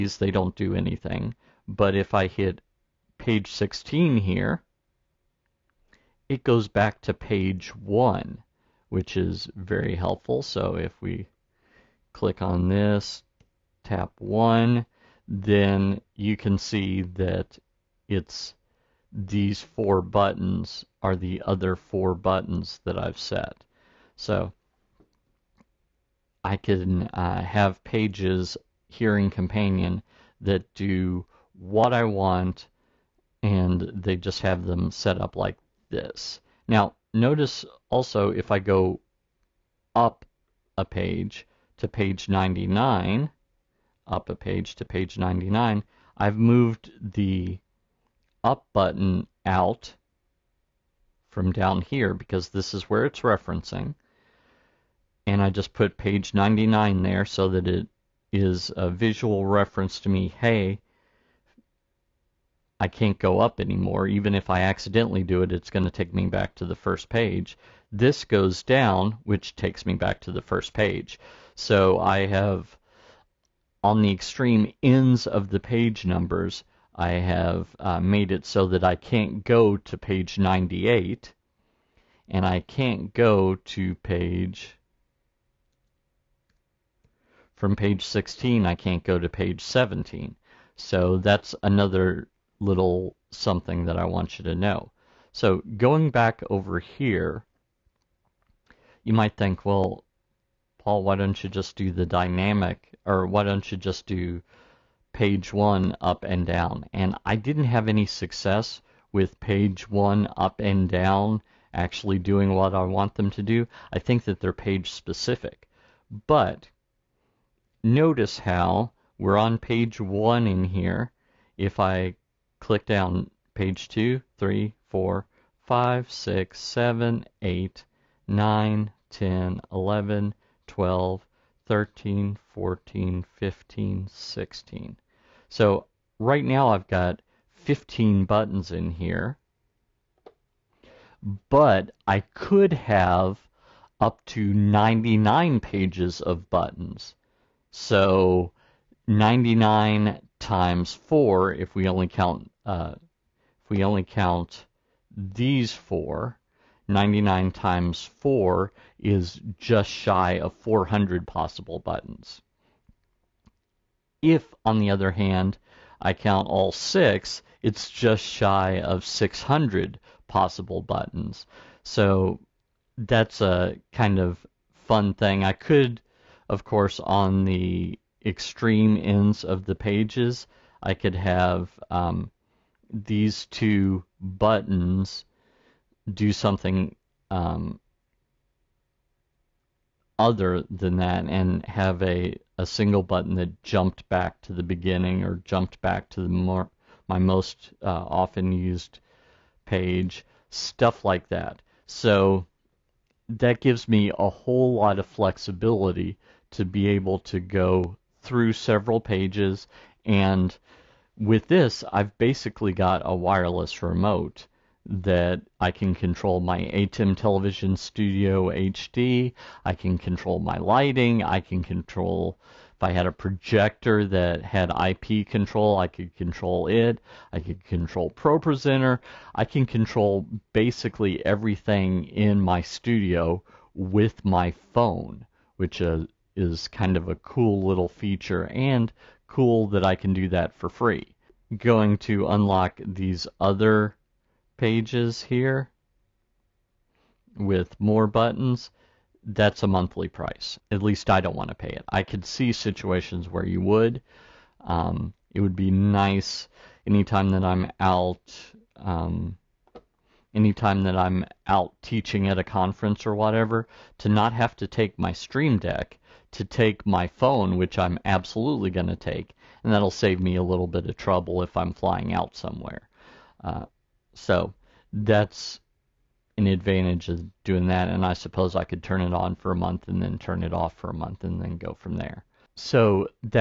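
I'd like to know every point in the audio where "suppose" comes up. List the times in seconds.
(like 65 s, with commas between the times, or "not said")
278 s.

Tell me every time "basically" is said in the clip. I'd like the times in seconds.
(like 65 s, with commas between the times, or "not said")
212 s, 230 s.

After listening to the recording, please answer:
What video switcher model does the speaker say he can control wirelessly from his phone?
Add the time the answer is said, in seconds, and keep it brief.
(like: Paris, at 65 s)
ATEM Television Studio HD, at 216 s.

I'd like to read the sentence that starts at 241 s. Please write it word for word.
Going to unlock these other pages here with more buttons, that's a monthly price.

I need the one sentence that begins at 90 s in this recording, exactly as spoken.
So that's another little something that I want you to know.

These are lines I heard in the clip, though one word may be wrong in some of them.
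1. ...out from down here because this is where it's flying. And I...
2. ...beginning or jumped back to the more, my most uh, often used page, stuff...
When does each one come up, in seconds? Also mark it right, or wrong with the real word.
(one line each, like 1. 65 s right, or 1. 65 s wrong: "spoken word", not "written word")
1. 49 s wrong: "referencing", not "flying"
2. 194 s right.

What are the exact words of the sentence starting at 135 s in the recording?
So right now I've got 15 buttons in here, but I could have up to 99 pages of buttons.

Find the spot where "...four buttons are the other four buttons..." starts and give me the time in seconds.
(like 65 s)
19 s.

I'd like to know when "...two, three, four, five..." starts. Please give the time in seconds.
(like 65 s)
123 s.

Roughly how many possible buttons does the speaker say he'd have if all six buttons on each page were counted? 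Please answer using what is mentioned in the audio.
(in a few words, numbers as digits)
Just shy of 600.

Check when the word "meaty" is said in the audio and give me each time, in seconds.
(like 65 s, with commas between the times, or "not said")
not said.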